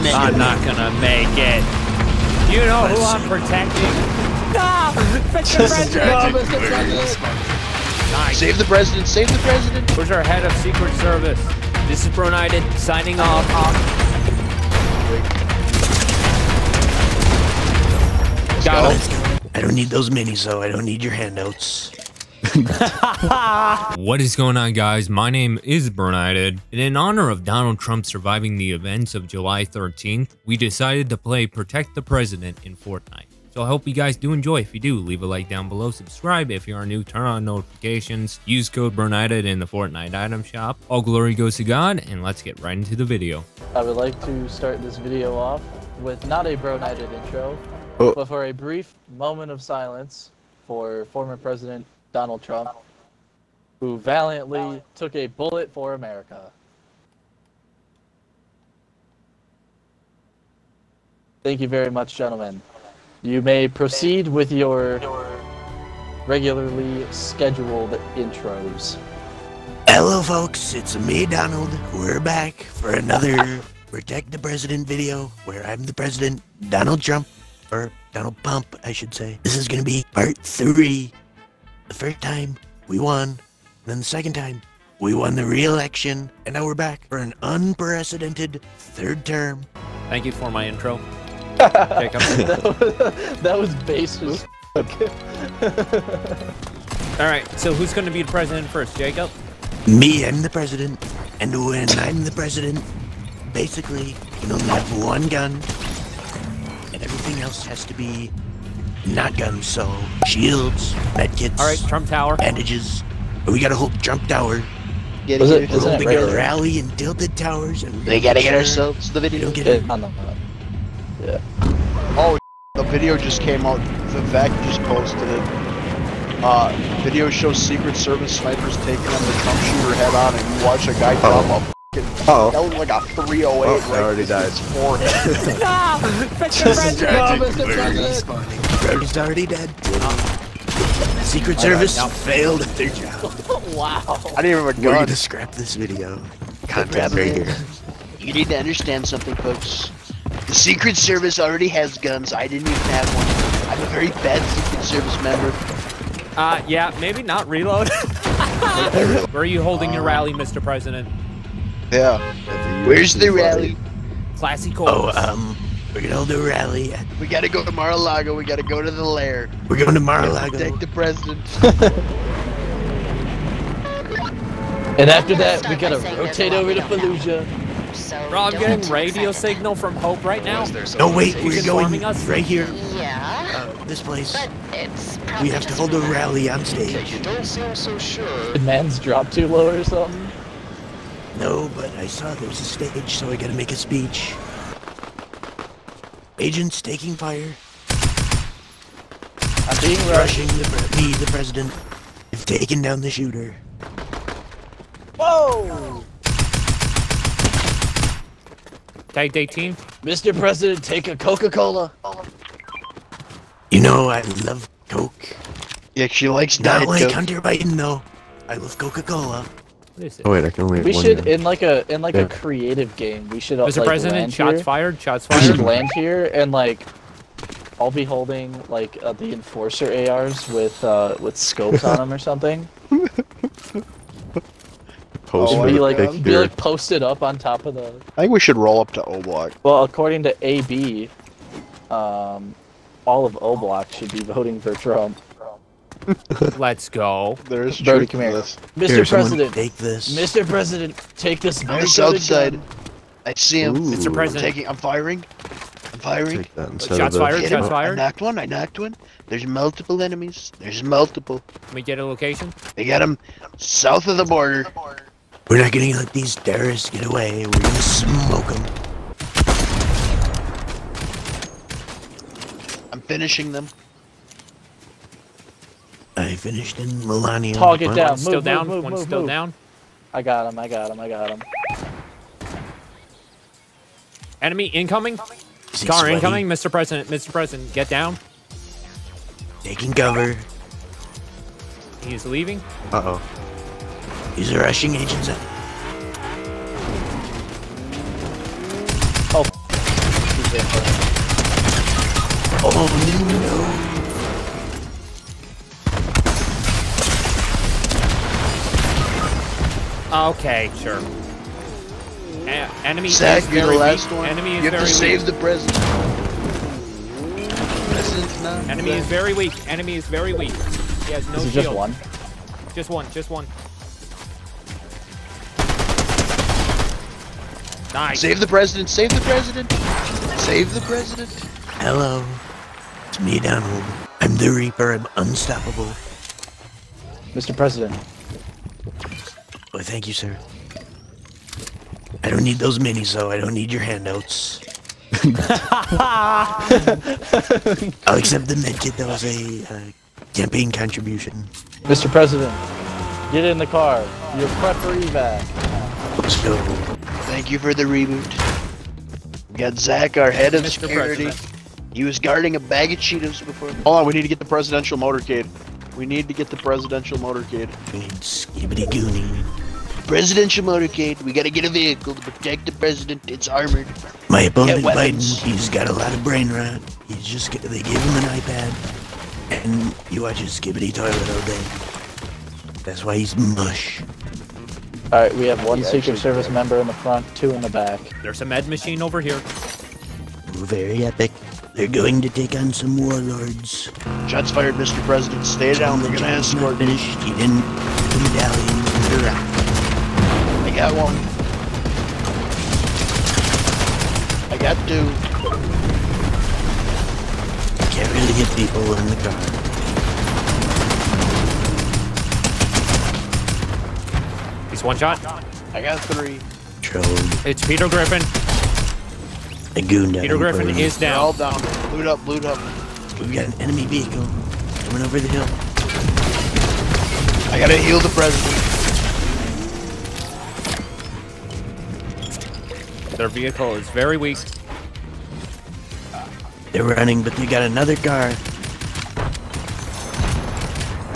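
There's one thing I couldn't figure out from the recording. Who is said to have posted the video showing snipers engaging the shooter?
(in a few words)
Vivek.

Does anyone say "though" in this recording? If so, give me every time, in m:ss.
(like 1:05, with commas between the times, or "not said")
0:20, 3:37, 5:43.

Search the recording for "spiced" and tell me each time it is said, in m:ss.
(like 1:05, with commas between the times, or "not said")
not said.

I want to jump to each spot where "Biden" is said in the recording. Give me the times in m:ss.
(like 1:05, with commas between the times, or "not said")
3:37, 6:14.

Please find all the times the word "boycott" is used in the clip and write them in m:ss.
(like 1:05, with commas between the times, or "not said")
not said.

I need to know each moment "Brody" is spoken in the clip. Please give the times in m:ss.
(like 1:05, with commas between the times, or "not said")
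2:18, 4:07.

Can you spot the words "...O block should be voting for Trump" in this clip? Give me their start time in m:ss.
4:03.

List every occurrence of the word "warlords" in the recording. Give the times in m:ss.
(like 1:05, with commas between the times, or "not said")
6:32.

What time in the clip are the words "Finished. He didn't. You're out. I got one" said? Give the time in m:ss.
6:36.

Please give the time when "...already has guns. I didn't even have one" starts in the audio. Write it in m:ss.
2:31.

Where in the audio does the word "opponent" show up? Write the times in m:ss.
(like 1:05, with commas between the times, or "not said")
6:14.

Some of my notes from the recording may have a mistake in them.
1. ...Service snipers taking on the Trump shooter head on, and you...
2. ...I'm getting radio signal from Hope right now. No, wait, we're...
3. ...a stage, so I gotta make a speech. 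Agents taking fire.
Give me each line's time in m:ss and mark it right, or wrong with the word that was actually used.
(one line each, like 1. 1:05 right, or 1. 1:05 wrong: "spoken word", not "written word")
1. 2:07 right
2. 2:58 right
3. 3:12 right.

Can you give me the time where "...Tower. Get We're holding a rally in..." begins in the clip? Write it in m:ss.
1:54.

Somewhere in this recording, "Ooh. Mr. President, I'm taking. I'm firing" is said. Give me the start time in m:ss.
4:13.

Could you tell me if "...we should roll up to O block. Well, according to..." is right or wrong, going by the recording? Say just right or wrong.
right.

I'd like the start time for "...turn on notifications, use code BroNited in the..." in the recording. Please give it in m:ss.
0:37.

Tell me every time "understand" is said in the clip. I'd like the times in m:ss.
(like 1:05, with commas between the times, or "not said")
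2:28.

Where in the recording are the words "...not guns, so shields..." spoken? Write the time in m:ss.
1:49.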